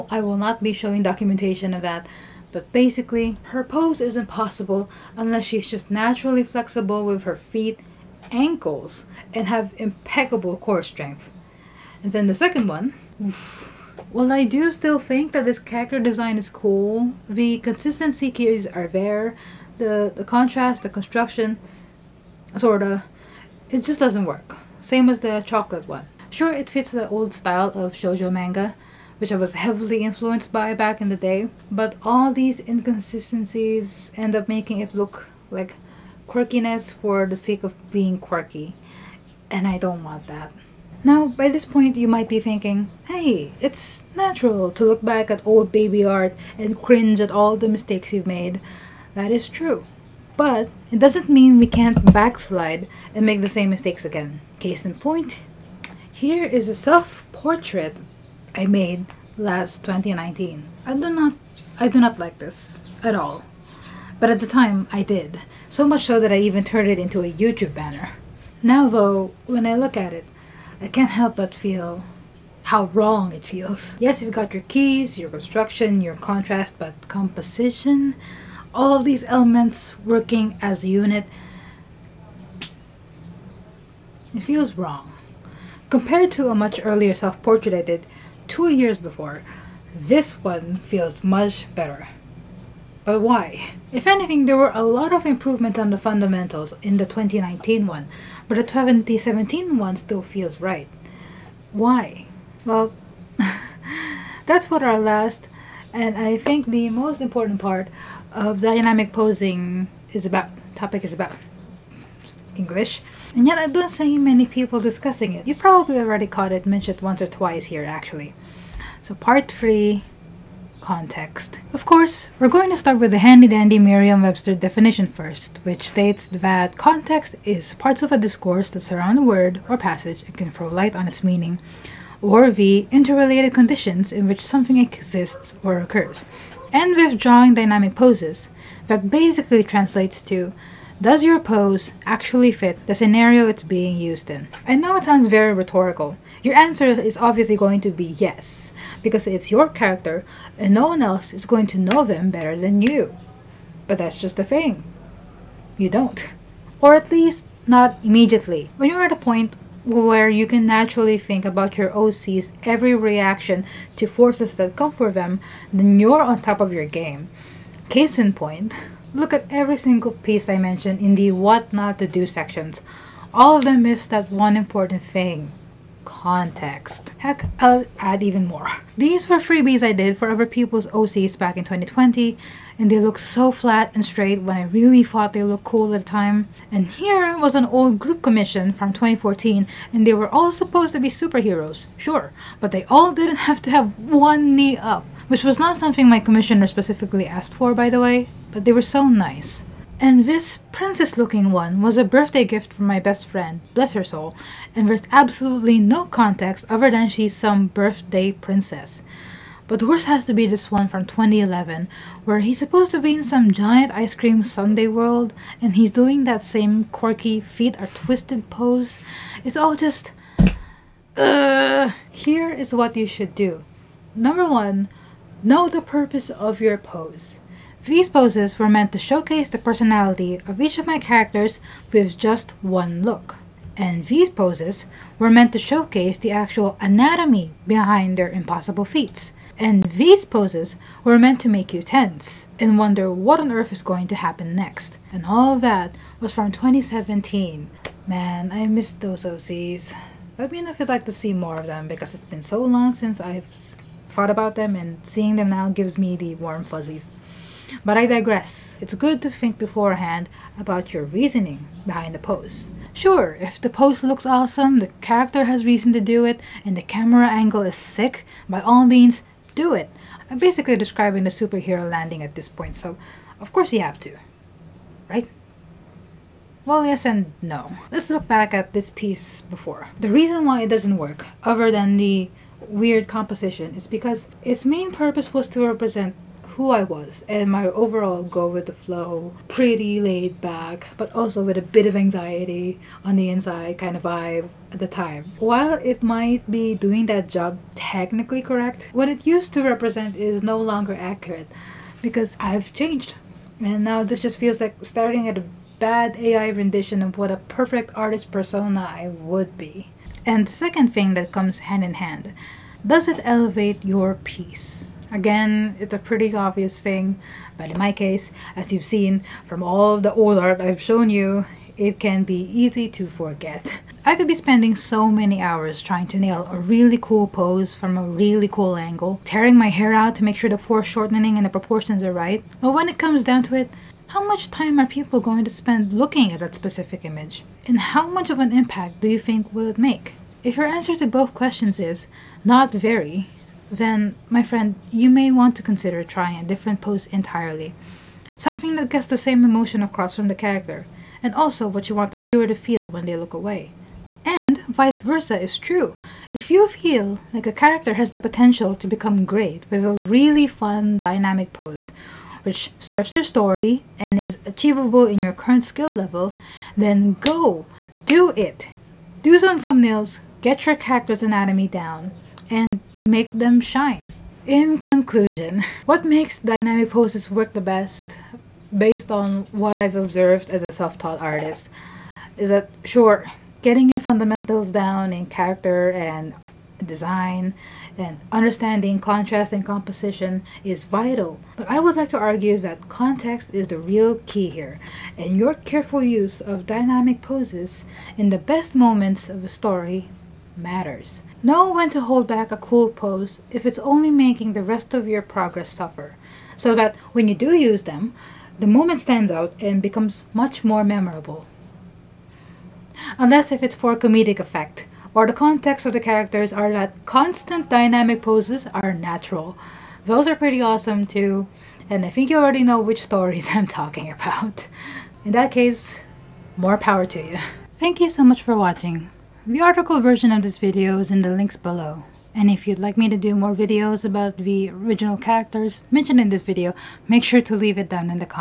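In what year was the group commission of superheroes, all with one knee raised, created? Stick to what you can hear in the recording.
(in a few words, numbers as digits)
2014.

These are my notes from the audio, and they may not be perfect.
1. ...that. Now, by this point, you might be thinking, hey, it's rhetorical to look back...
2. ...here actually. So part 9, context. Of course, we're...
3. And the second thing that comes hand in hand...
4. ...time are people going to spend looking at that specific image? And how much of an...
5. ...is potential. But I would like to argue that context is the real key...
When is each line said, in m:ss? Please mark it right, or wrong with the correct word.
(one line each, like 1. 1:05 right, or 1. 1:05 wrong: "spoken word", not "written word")
1. 0:40 wrong: "natural", not "rhetorical"
2. 1:57 wrong: "3", not "9"
3. 5:10 right
4. 5:34 right
5. 6:30 wrong: "vital", not "potential".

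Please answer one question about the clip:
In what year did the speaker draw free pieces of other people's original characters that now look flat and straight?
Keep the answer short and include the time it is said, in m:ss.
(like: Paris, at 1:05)
2020, at 3:01.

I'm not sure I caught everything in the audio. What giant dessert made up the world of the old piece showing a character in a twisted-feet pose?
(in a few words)
ice cream sundae.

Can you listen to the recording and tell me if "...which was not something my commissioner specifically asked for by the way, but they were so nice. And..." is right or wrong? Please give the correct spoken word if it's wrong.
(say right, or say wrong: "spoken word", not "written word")
right.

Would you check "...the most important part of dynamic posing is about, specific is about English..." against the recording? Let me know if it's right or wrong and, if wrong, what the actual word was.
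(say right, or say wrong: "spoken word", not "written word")
wrong: "topic", not "specific".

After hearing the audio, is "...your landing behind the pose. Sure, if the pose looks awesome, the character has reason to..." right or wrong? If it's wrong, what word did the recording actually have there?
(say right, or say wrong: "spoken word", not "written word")
wrong: "reasoning", not "landing".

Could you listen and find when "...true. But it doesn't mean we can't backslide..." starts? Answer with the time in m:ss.
0:49.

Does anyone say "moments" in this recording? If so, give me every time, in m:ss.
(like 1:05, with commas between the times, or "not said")
6:38, 6:48.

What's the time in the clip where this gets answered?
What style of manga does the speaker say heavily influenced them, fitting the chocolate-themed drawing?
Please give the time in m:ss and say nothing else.
0:27.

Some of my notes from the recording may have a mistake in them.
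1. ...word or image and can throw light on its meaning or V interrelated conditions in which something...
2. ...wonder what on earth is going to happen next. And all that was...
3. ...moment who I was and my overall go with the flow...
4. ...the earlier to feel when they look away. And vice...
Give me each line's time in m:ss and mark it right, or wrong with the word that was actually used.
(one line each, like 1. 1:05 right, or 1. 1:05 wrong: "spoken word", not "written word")
1. 2:09 wrong: "passage", not "image"
2. 4:02 right
3. 4:45 wrong: "represent", not "moment"
4. 5:52 wrong: "viewer", not "earlier".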